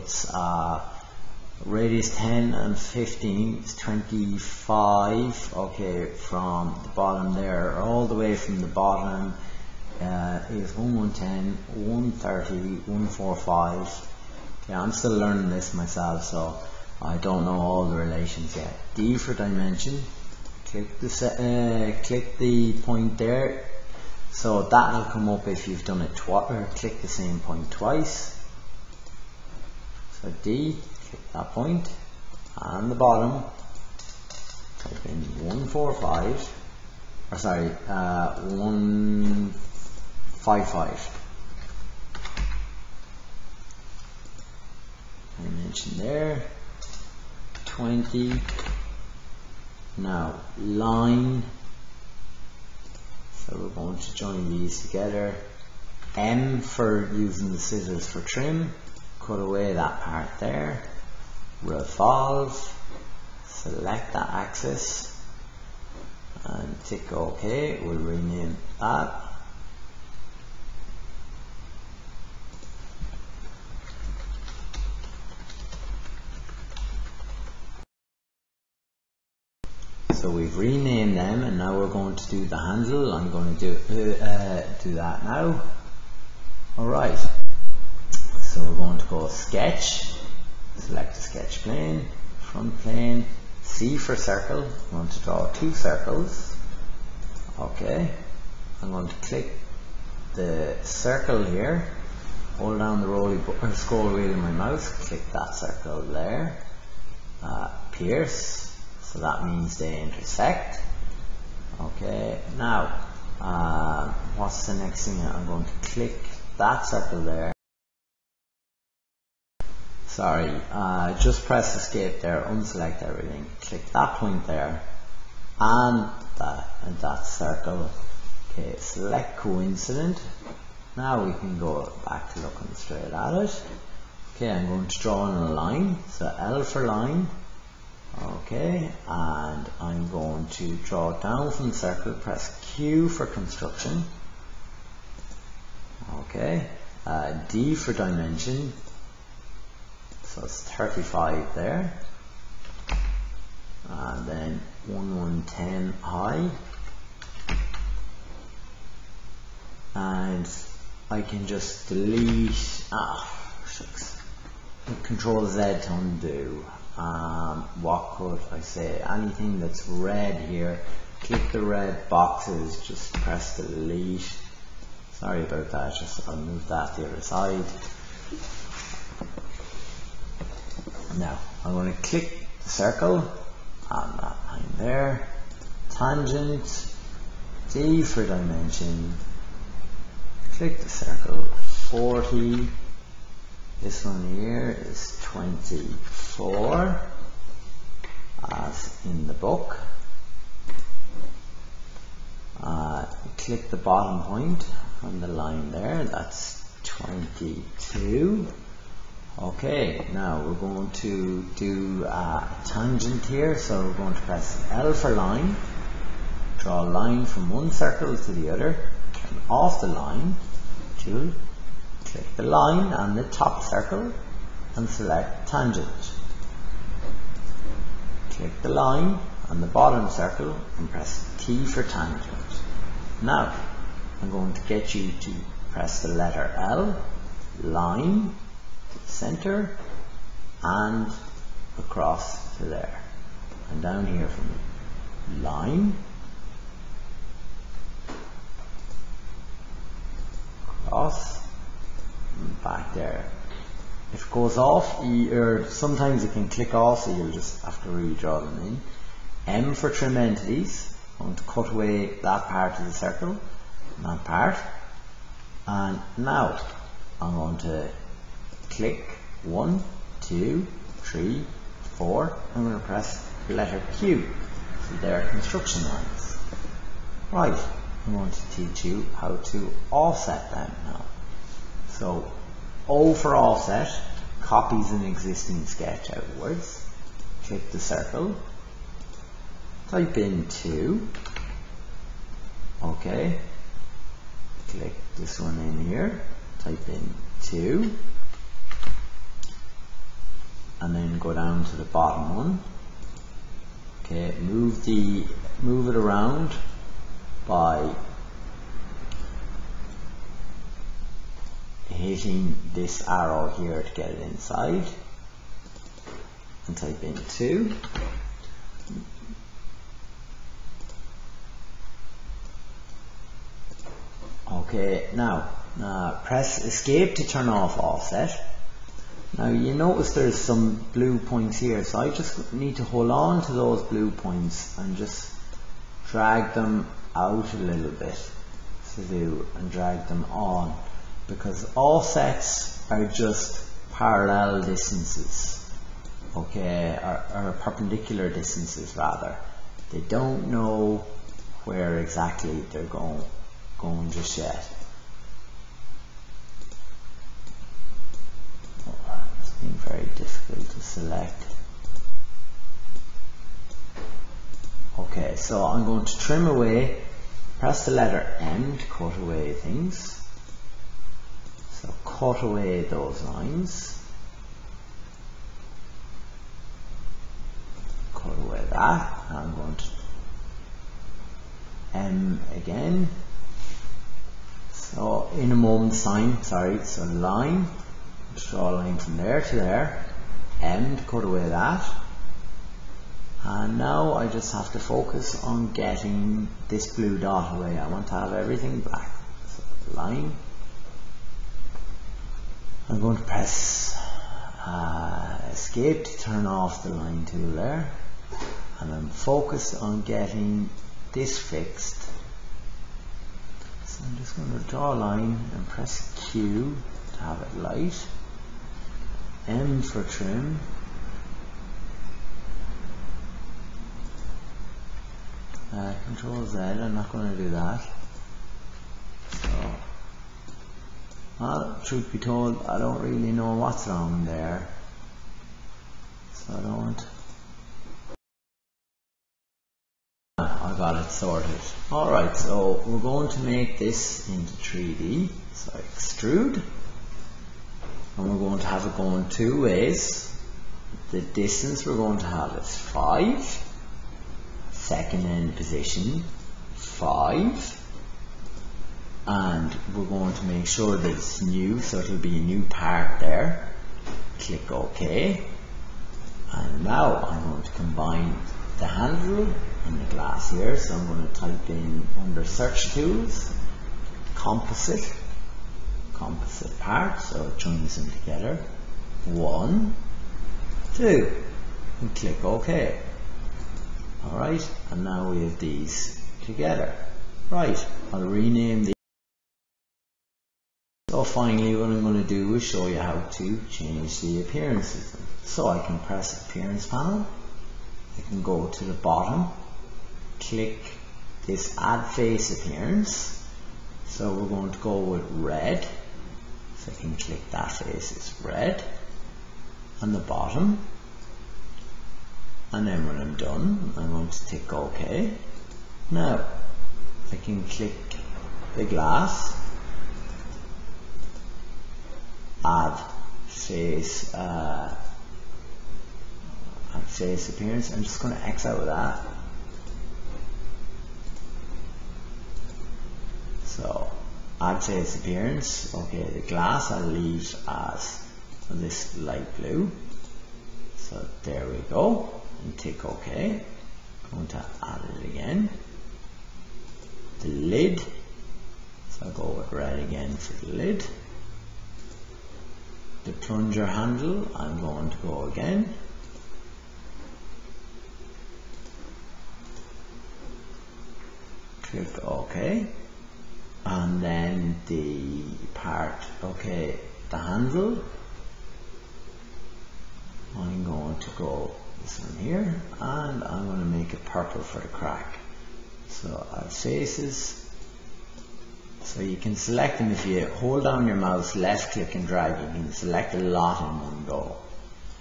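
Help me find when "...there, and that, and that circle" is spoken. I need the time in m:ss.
2:04.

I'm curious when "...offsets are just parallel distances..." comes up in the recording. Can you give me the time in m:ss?
5:41.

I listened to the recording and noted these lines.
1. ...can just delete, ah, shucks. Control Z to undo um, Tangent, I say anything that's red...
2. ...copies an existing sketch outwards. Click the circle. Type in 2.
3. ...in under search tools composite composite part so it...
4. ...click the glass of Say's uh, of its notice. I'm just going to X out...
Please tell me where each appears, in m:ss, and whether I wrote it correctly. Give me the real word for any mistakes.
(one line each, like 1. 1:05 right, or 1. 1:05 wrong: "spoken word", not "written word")
1. 2:41 wrong: "Walkfoot", not "Tangent"
2. 4:44 right
3. 7:51 right
4. 8:37 wrong: "appearance", not "notice".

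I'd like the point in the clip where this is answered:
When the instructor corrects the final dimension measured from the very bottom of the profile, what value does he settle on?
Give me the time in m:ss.
0:38.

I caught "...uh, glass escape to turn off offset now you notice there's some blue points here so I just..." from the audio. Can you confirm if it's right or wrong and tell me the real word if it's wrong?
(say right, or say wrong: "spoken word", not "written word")
wrong: "press", not "glass".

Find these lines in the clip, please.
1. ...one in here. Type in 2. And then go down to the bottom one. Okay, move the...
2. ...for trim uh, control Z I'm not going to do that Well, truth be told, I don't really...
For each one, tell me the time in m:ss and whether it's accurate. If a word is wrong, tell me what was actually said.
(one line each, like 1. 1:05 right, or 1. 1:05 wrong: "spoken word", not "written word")
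1. 4:55 right
2. 6:59 right.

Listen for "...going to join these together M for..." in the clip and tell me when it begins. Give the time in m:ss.
0:53.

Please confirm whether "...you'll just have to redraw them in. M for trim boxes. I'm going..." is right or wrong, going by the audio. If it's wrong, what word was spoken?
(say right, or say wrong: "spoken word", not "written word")
wrong: "entities", not "boxes".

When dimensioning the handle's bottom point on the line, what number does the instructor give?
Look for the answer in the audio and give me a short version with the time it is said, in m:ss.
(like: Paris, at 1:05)
22, at 3:26.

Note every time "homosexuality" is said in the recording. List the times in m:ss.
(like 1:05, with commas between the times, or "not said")
not said.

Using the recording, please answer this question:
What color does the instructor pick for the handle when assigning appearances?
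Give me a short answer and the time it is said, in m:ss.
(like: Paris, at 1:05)
purple, at 9:34.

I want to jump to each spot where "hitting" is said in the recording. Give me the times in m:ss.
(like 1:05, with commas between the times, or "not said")
5:11.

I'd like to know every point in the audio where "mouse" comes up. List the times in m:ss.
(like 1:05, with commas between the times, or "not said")
1:44, 9:41.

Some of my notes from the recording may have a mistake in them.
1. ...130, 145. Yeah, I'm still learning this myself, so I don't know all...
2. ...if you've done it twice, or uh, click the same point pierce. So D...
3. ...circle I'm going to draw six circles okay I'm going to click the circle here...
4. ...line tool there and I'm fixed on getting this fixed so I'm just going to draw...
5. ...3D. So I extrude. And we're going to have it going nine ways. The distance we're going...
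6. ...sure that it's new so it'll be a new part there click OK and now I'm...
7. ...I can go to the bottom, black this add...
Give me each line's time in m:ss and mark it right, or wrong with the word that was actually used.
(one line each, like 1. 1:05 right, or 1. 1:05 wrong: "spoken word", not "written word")
1. 0:11 right
2. 0:25 wrong: "twice", not "pierce"
3. 1:34 wrong: "two", not "six"
4. 6:46 wrong: "focused", not "fixed"
5. 7:24 wrong: "two", not "nine"
6. 7:40 right
7. 8:18 wrong: "click", not "black".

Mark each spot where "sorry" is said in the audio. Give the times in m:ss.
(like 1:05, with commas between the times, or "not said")
0:37, 2:00, 2:55, 6:26.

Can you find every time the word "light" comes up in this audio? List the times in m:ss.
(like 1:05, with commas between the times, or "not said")
6:57, 8:59.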